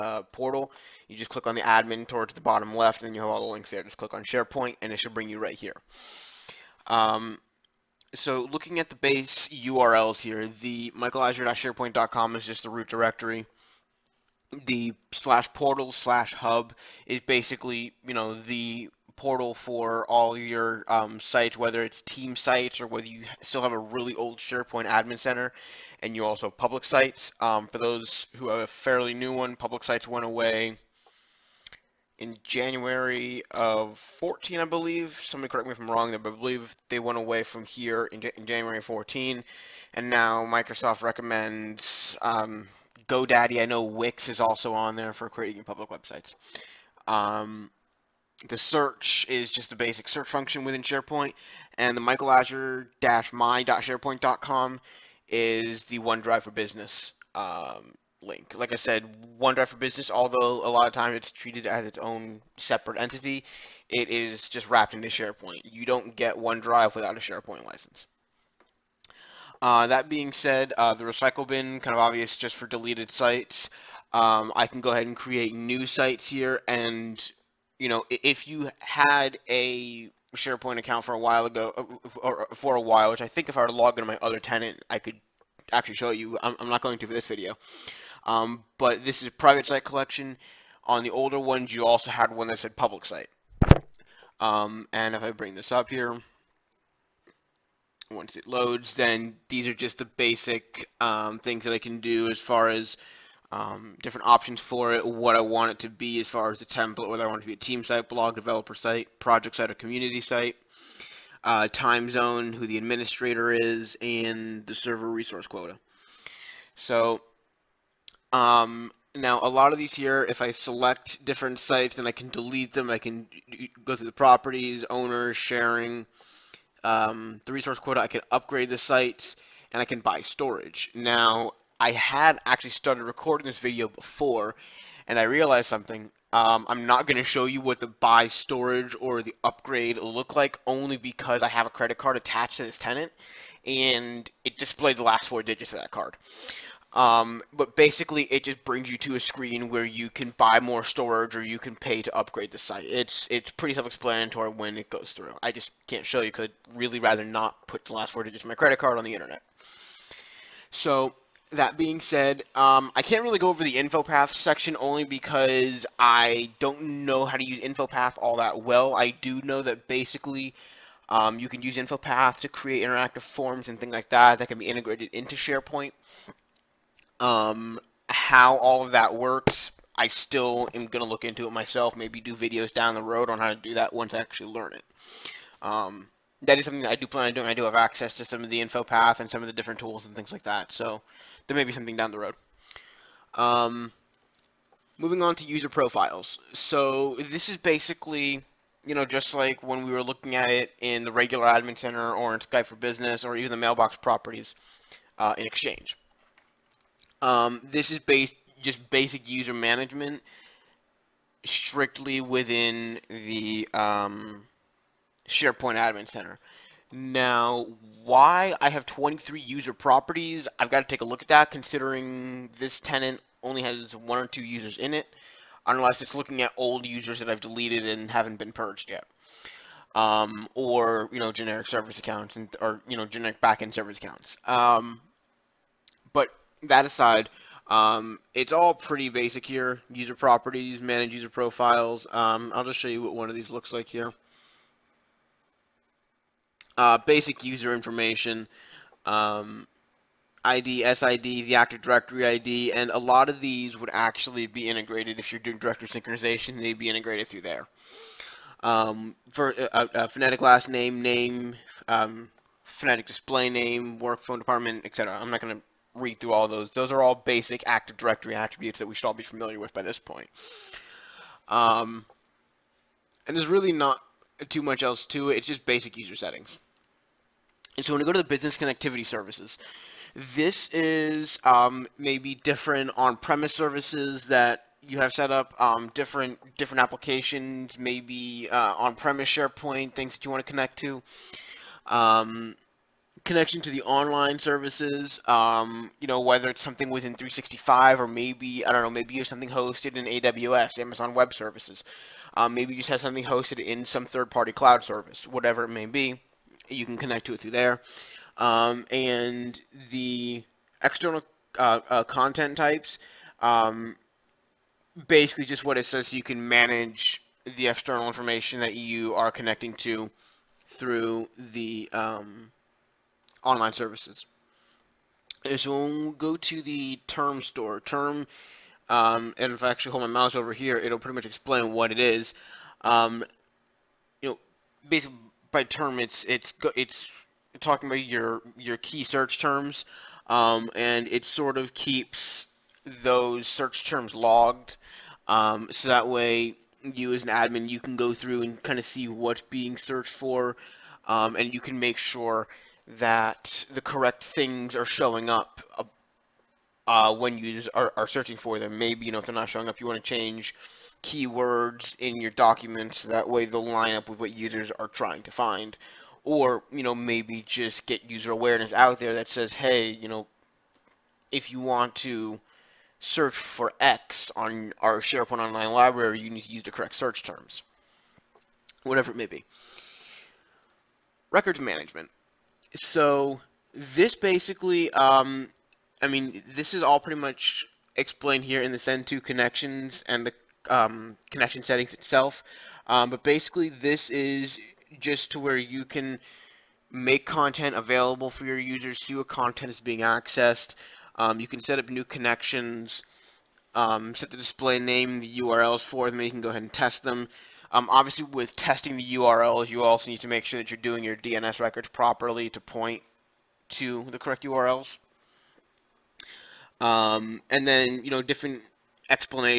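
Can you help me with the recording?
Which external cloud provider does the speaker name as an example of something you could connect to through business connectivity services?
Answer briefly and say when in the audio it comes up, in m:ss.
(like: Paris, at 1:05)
Amazon Web Services, at 5:00.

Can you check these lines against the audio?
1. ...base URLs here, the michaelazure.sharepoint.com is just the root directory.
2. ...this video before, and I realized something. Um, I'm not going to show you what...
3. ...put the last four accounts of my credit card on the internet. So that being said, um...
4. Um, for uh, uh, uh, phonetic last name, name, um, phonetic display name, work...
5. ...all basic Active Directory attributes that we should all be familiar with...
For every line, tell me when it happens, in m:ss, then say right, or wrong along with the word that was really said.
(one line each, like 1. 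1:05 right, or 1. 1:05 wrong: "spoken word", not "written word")
1. 0:08 right
2. 2:13 right
3. 2:37 wrong: "digits", not "accounts"
4. 4:18 right
5. 4:27 right.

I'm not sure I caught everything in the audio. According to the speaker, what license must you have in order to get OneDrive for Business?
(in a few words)
SharePoint license.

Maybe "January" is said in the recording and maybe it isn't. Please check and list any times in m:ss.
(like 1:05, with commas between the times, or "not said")
0:32, 0:38.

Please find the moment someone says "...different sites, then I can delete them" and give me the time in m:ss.
2:01.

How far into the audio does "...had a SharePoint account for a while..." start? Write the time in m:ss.
1:18.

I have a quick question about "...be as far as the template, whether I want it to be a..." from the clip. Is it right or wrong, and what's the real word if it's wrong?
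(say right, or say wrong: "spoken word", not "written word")
right.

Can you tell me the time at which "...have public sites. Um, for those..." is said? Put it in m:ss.
0:26.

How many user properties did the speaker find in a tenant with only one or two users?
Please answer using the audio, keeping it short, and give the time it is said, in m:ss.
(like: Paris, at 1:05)
23, at 3:38.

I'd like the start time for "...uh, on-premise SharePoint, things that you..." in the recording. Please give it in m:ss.
4:48.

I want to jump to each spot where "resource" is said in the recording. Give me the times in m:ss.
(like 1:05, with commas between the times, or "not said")
1:55, 2:07.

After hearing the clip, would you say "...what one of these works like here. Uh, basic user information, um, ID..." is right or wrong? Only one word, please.
wrong.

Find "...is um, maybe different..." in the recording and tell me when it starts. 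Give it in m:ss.
4:40.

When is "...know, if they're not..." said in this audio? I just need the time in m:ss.
5:59.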